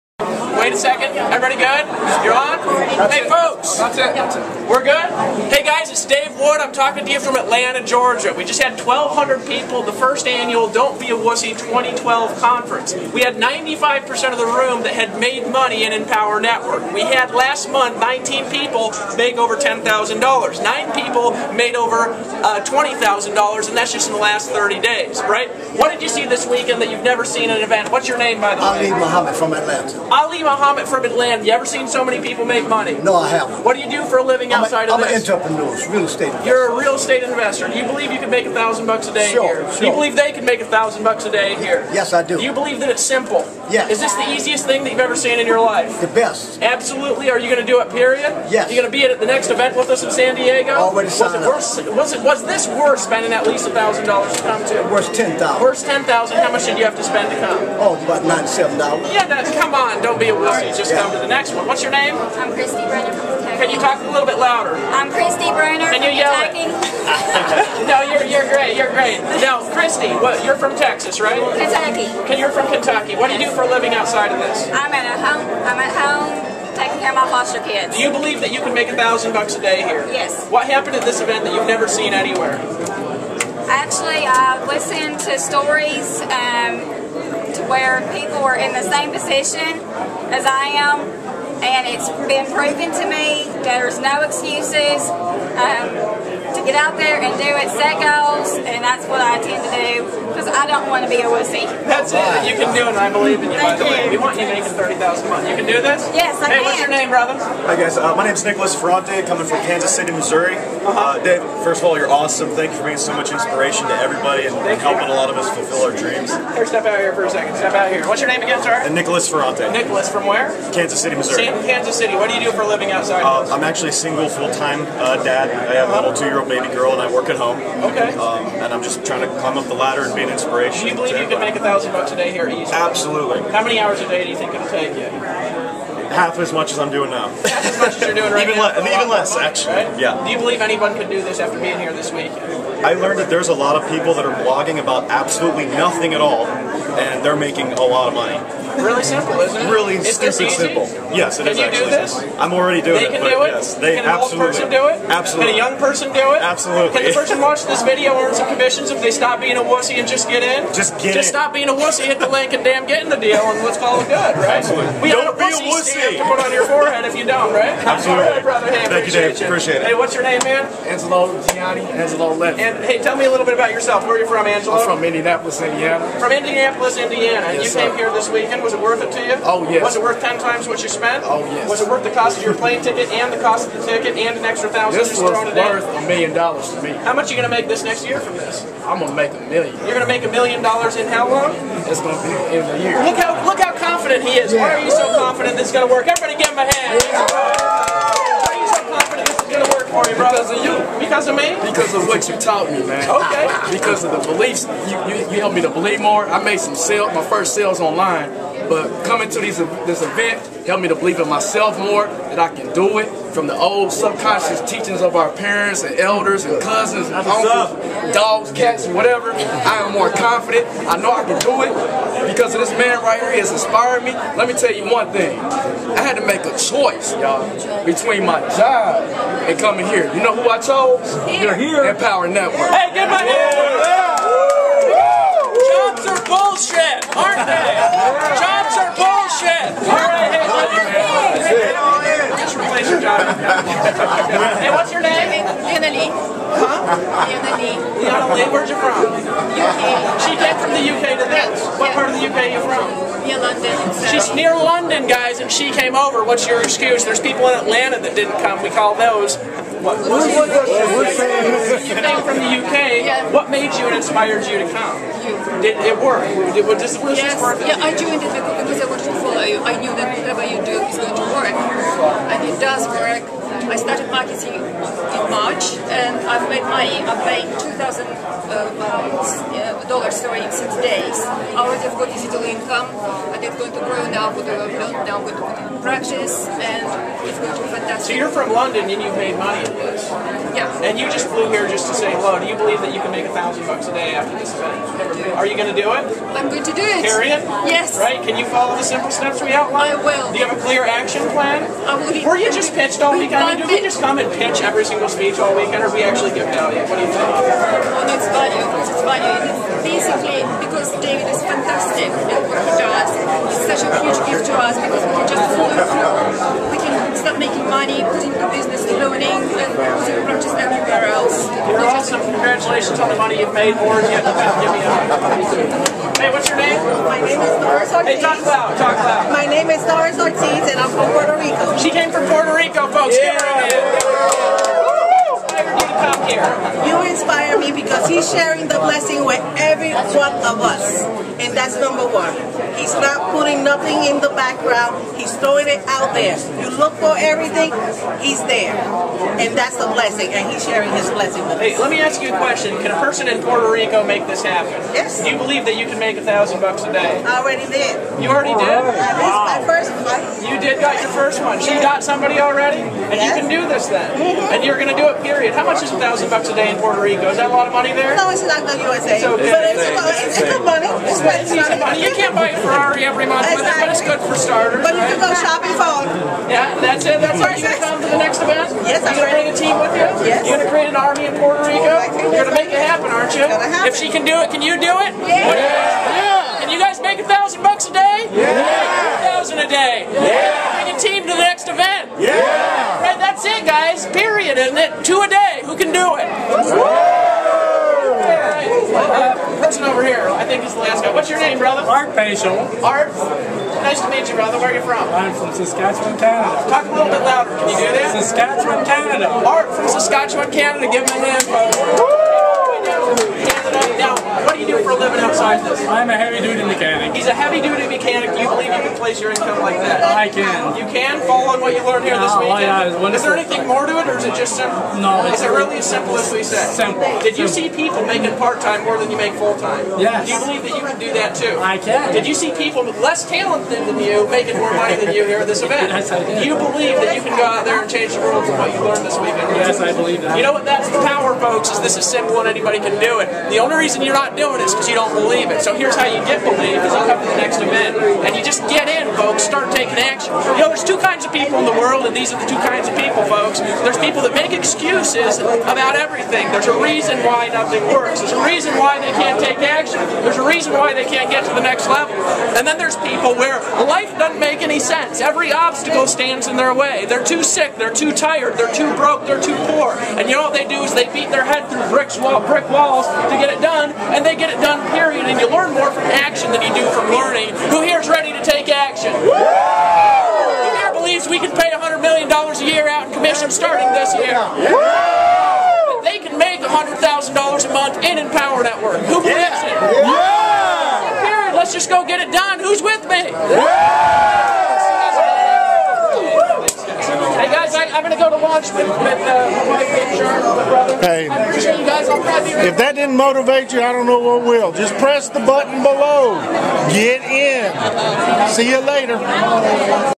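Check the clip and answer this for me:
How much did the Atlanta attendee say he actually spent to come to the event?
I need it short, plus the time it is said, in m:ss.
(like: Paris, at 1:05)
$97, at 0:58.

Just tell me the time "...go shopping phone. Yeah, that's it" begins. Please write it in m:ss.
6:15.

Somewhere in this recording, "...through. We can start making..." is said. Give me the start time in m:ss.
5:15.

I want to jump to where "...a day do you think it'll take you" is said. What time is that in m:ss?
2:14.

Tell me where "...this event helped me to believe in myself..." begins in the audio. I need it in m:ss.
3:29.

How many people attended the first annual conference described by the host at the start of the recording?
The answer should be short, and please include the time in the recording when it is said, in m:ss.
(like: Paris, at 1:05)
1,200, at 0:08.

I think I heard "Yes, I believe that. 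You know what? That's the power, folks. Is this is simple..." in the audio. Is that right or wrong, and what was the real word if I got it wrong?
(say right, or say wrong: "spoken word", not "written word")
right.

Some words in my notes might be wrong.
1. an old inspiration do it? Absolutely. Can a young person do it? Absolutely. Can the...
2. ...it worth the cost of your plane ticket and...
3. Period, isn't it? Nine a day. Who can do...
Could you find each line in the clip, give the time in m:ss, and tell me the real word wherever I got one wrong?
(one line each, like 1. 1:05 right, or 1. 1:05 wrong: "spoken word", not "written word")
1. 2:34 wrong: "person", not "inspiration"
2. 3:01 right
3. 6:34 wrong: "Two", not "Nine".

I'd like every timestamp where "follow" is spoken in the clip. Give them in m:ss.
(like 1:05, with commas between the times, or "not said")
4:29, 4:58, 5:15, 7:01.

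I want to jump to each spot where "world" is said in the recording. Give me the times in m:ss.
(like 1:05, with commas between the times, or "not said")
7:18, 7:31.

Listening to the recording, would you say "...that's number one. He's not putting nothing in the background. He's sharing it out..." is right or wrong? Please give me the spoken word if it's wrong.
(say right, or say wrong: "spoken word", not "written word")
wrong: "throwing", not "sharing".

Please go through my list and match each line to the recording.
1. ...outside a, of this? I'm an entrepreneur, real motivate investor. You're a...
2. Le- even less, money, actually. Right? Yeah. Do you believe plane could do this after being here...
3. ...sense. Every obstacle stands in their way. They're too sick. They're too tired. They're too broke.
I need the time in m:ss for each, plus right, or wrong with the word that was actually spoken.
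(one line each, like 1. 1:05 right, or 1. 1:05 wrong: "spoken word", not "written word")
1. 0:34 wrong: "estate", not "motivate"
2. 2:18 wrong: "anyone", not "plane"
3. 7:44 right.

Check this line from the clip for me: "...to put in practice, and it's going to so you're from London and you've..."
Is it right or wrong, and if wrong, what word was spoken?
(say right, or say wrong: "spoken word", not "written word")
right.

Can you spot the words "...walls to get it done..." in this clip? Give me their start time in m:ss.
7:52.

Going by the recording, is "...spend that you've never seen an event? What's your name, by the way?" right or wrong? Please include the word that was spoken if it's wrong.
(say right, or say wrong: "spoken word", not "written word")
wrong: "weekend", not "spend".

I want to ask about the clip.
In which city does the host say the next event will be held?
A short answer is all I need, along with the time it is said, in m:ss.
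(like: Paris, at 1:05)
San Diego, at 0:50.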